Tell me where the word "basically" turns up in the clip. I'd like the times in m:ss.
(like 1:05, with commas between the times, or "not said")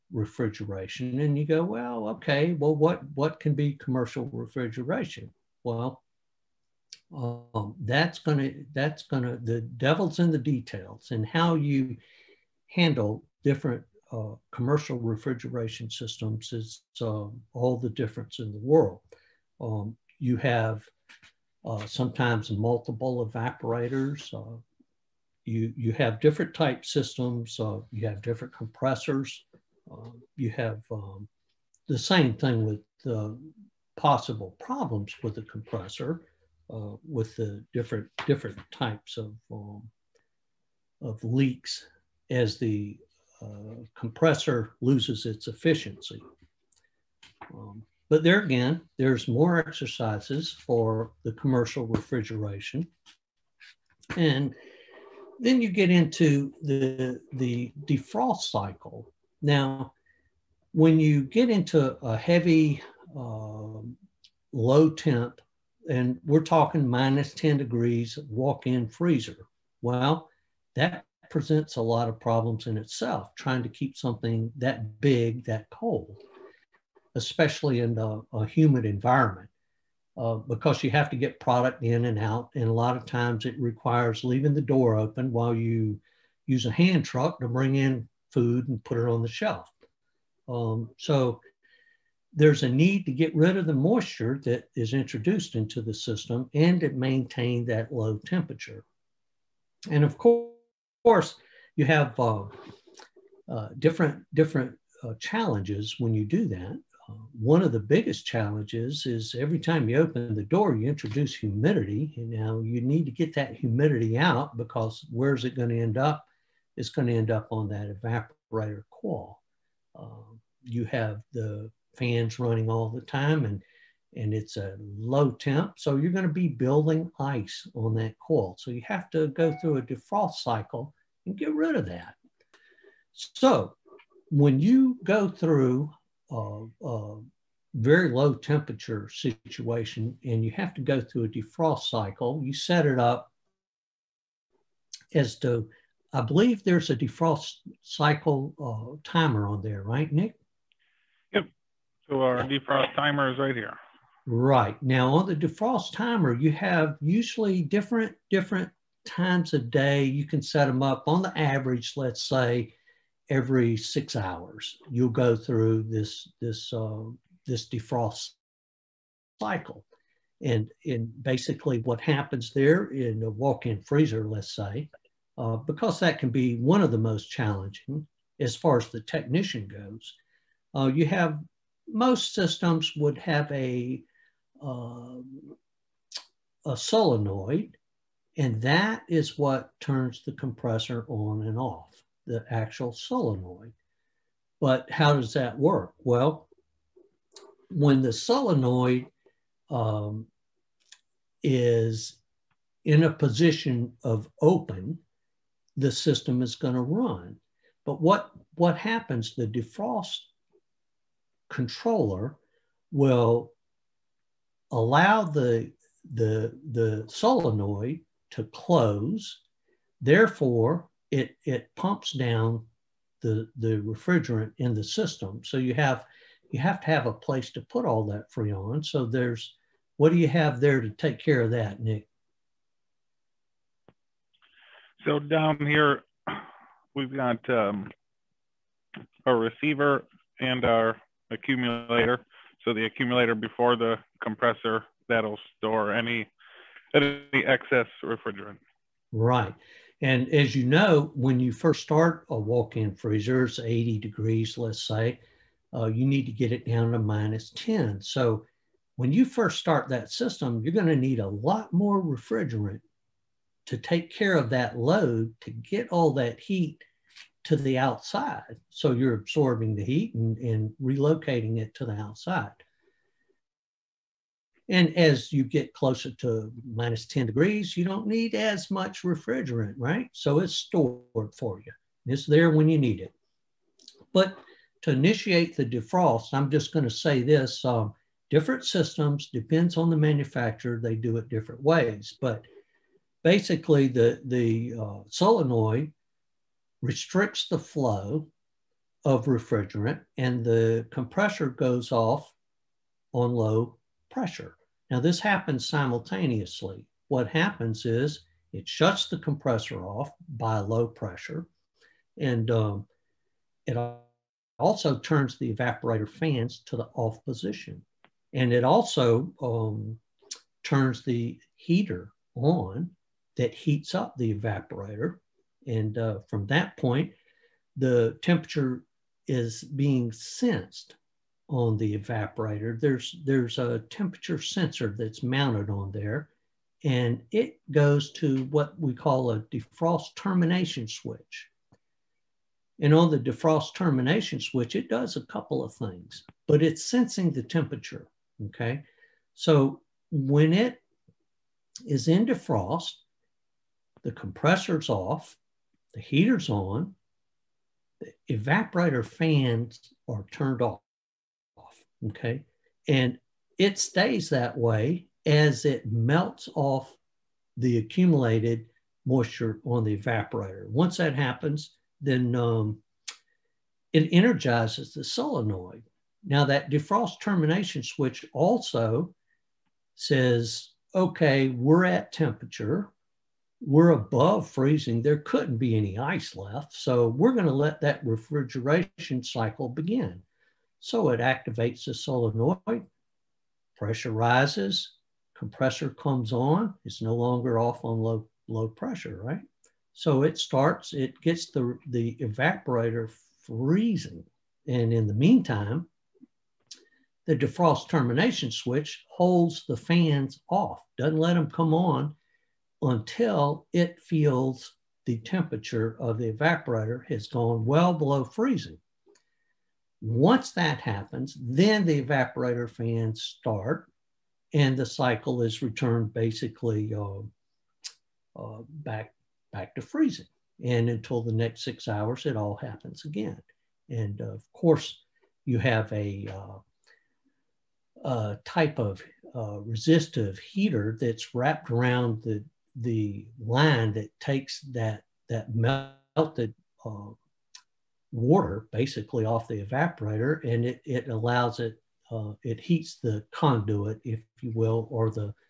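2:51, 4:53, 7:06, 7:28.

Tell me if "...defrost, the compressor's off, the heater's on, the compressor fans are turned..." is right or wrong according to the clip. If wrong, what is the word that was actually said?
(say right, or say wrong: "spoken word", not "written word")
wrong: "evaporator", not "compressor".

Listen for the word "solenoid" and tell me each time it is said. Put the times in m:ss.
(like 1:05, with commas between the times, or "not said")
3:06, 3:12, 3:18, 3:37, 4:55, 6:15, 6:31.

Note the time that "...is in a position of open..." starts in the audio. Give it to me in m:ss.
3:21.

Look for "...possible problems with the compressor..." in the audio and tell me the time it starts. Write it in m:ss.
0:33.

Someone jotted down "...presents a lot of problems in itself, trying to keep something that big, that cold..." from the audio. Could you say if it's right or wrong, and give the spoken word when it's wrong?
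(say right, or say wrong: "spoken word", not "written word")
right.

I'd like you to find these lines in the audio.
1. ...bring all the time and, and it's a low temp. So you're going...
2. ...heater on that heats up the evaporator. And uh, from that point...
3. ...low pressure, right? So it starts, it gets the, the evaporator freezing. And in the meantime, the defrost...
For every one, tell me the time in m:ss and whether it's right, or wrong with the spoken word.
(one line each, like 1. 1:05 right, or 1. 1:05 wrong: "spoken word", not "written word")
1. 2:02 wrong: "running", not "bring"
2. 5:21 right
3. 6:38 right.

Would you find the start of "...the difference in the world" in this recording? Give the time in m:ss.
0:17.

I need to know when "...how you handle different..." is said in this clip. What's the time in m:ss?
0:11.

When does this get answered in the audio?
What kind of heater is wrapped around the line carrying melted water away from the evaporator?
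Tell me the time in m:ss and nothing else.
7:19.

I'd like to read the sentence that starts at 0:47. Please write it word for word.
Um, but there again, there's more exercises for the commercial refrigeration.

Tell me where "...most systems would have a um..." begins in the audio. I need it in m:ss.
3:01.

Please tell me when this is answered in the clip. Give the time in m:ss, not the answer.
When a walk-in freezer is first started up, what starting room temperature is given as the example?
4:13.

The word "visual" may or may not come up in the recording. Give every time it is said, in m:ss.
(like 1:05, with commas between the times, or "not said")
not said.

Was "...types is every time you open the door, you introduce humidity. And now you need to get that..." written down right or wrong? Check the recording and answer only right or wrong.
wrong.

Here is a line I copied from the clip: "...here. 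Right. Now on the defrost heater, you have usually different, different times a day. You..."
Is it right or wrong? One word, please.
wrong.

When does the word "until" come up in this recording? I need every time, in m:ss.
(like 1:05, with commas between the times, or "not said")
6:52, 7:10.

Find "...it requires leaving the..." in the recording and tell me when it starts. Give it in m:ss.
1:23.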